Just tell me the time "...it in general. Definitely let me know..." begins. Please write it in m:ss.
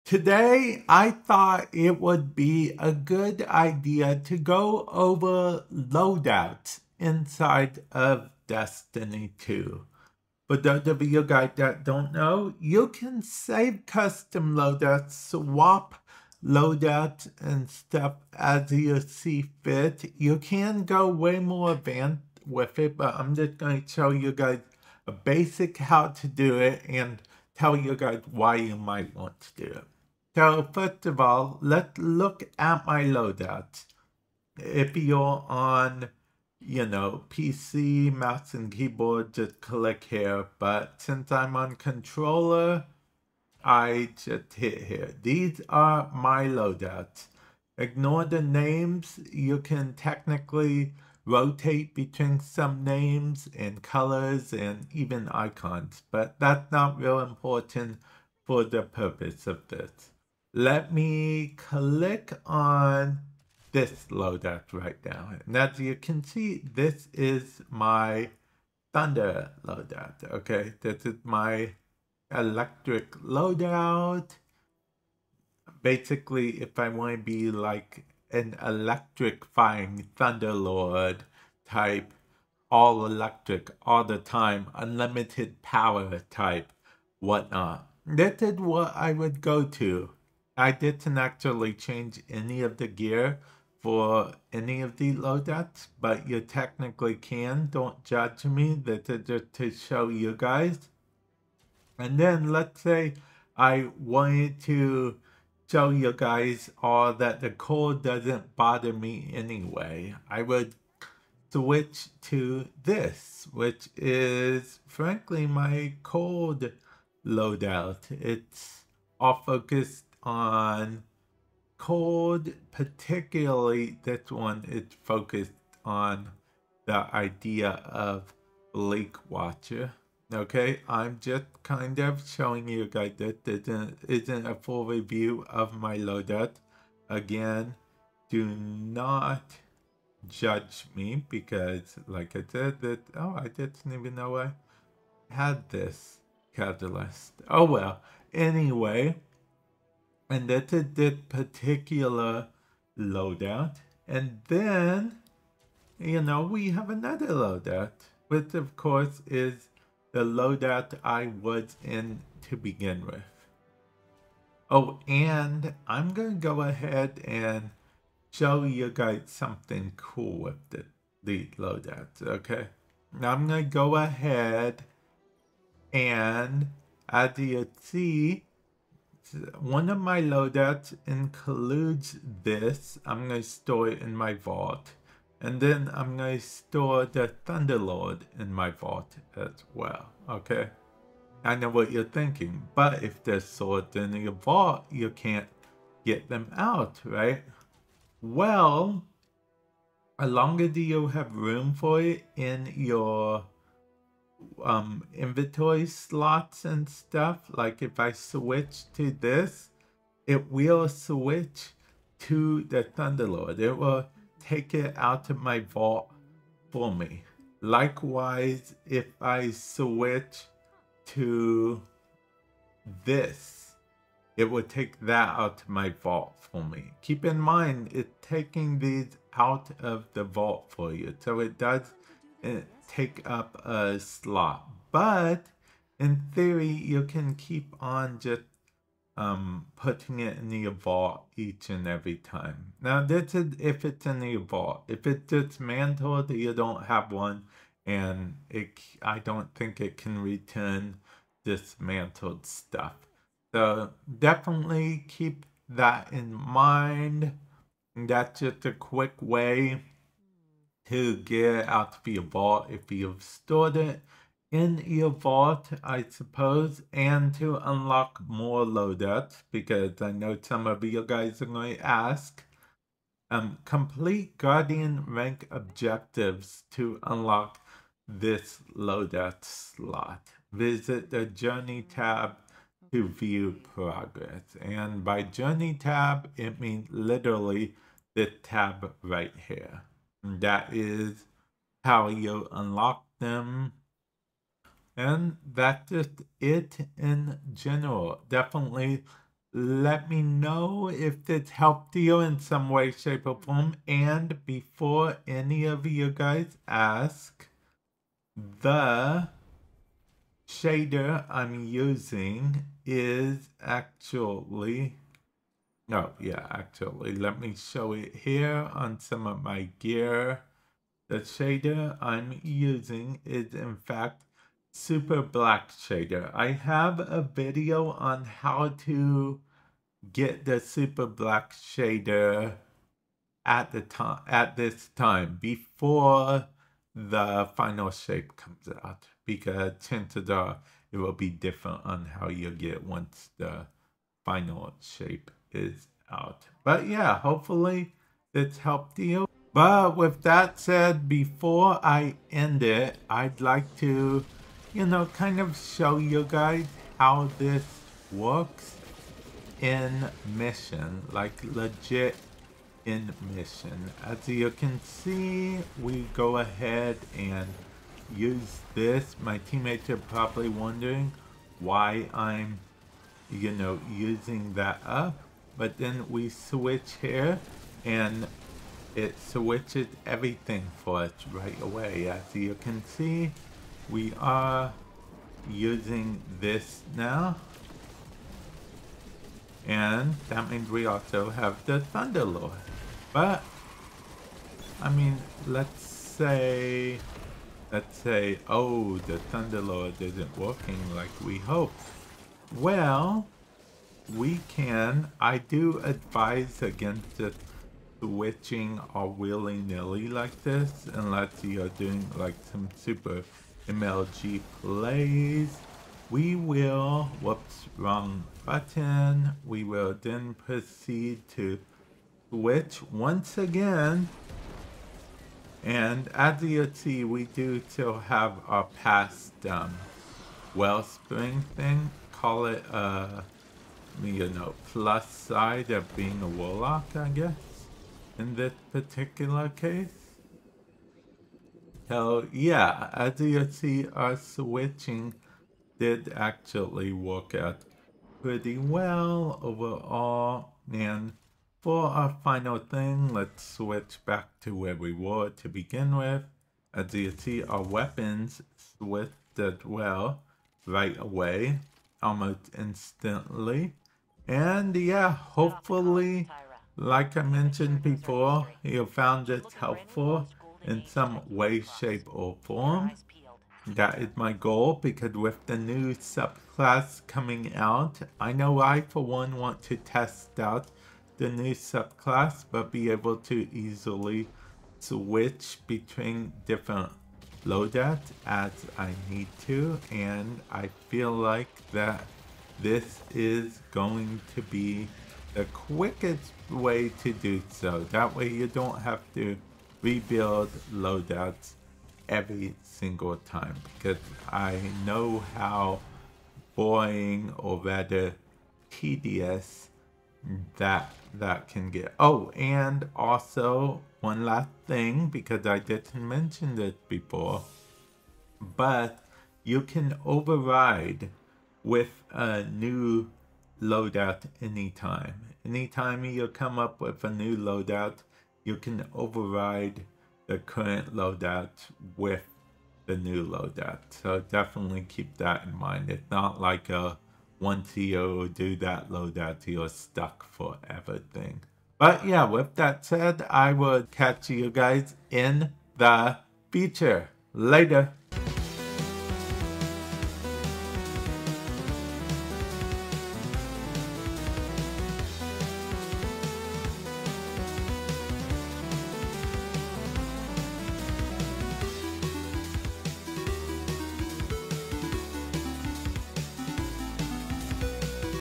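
4:56.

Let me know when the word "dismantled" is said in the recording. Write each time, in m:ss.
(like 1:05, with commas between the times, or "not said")
4:05, 4:11.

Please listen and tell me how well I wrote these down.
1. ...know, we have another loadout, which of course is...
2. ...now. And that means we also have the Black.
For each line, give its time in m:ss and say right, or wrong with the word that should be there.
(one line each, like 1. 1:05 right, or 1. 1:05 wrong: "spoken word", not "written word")
1. 2:36 right
2. 6:26 wrong: "Thunderlord", not "Black".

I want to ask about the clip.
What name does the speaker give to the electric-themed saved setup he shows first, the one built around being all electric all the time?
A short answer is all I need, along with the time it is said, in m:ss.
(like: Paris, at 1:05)
Thunder loadout, at 1:08.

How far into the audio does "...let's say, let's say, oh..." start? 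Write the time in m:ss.
6:35.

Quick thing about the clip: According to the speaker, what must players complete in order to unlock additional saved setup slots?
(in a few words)
Guardian rank objectives.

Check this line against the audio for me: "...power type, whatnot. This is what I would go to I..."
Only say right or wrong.
right.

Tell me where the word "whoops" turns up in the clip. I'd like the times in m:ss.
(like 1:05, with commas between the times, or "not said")
6:57.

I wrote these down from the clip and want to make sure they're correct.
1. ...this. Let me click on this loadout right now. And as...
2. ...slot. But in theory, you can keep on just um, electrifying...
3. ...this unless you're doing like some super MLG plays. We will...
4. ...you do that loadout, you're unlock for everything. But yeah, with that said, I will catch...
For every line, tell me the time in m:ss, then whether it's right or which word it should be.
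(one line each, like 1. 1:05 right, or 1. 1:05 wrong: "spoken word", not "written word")
1. 0:59 right
2. 3:53 wrong: "putting", not "electrifying"
3. 6:50 right
4. 8:57 wrong: "stuck", not "unlock".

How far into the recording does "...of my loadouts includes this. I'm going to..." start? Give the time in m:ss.
2:59.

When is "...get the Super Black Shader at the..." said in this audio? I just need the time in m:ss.
5:30.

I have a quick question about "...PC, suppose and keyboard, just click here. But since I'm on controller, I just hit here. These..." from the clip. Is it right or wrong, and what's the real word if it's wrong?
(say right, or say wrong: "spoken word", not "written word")
wrong: "mouse", not "suppose".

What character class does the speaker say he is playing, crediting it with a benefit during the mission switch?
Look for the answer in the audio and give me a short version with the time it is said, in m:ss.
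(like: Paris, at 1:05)
Warlock, at 7:16.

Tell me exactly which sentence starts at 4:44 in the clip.
And by Journey tab, it means literally the tab right here.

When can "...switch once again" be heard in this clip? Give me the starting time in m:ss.
7:02.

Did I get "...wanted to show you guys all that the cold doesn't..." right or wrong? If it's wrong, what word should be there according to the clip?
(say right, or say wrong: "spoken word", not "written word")
right.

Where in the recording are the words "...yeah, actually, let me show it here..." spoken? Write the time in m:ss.
5:16.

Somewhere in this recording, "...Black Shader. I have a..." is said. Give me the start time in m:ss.
5:25.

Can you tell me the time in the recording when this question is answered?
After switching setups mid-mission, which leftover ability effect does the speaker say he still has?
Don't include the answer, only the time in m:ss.
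7:10.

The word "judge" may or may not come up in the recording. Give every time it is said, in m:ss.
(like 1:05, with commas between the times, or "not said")
1:38, 2:20.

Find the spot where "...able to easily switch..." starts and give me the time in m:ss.
8:02.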